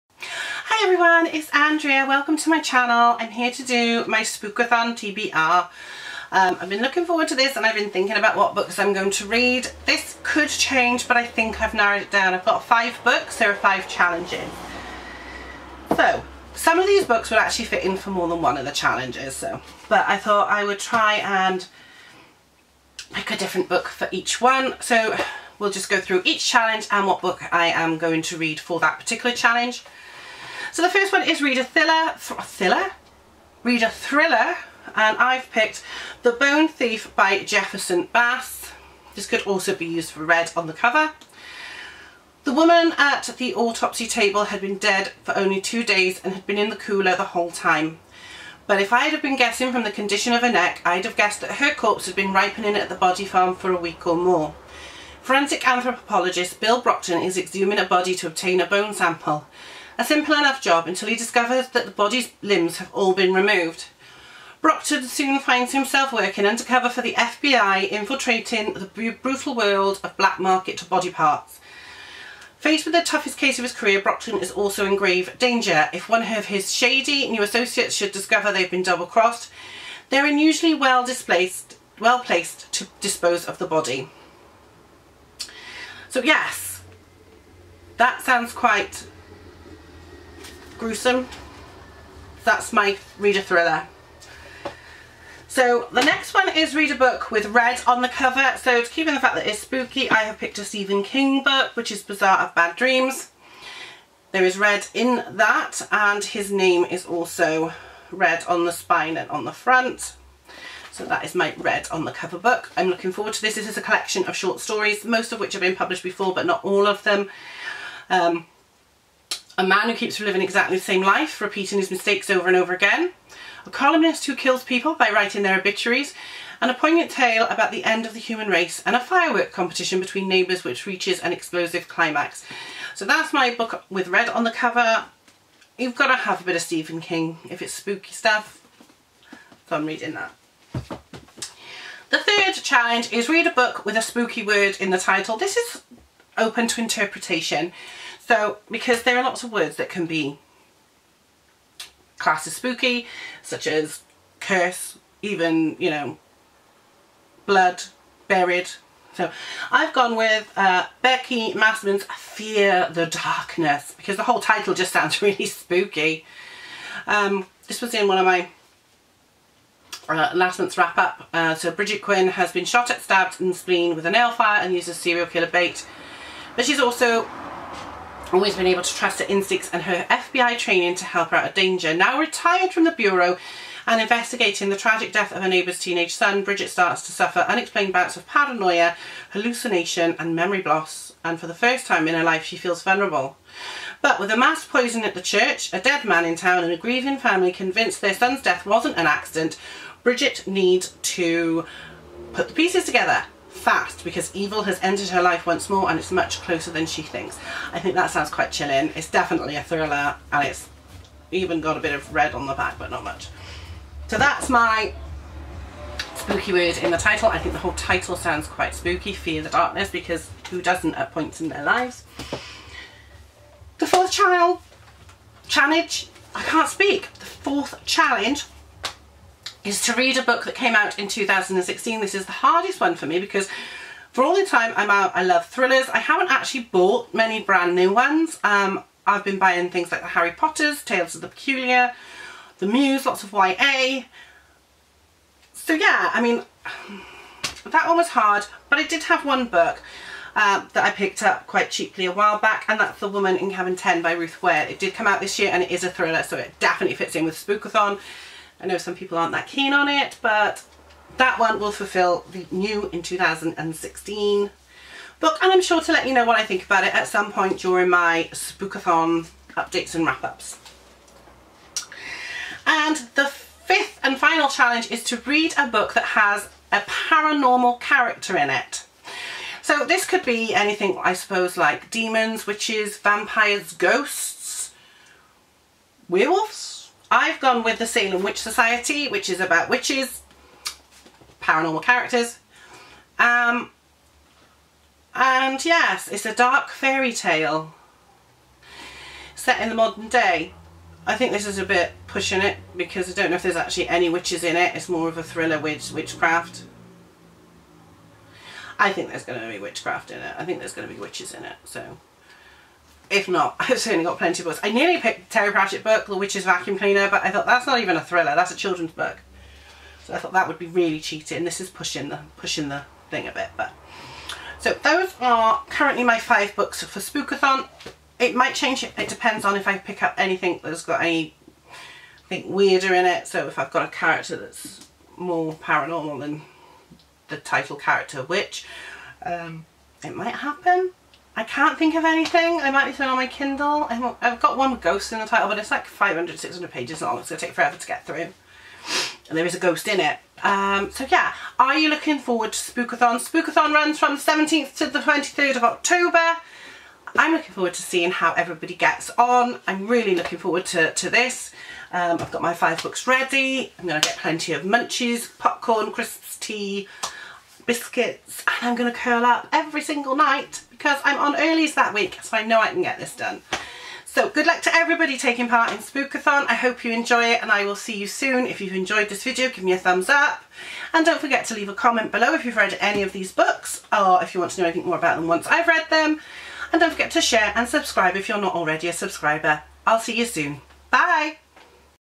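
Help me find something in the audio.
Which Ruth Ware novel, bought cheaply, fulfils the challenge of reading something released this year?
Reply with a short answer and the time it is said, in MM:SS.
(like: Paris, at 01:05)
The Woman in Cabin 10, at 04:12.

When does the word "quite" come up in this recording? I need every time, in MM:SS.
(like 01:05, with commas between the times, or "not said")
01:28, 03:28, 03:38, 04:11.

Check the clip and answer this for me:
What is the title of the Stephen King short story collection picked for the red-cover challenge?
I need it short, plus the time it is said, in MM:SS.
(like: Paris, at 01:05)
Bazaar of Bad Dreams, at 01:42.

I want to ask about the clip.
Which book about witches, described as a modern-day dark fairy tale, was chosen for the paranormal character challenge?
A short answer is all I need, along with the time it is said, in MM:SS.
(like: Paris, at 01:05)
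Salem Witch Society, at 04:47.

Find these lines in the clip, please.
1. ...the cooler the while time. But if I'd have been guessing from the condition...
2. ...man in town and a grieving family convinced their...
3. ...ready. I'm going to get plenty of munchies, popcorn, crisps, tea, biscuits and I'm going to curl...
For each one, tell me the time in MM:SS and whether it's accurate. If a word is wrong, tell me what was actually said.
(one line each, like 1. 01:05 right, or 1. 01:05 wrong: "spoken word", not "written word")
1. 00:46 wrong: "whole", not "while"
2. 03:16 right
3. 06:03 right.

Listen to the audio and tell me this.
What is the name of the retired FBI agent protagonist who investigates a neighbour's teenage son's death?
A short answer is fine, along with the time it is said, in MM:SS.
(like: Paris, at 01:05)
Brigid Quinn, at 02:51.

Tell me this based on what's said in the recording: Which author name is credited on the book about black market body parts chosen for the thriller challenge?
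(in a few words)
Jefferson Bass.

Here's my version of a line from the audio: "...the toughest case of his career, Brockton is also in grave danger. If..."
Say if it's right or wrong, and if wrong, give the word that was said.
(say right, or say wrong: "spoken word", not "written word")
right.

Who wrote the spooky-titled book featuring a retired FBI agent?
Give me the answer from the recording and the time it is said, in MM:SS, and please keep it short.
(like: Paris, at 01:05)
Becky Masterman, at 02:41.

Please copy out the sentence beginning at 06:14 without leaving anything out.
So good luck to everybody taking part in Spookathon.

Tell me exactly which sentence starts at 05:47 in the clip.
It's going to take forever to get through.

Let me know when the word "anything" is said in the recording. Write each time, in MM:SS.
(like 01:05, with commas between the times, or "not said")
04:40, 05:30, 05:42, 06:24.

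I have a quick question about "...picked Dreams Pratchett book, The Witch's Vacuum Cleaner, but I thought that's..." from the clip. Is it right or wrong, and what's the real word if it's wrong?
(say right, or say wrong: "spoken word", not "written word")
wrong: "Terry", not "Dreams".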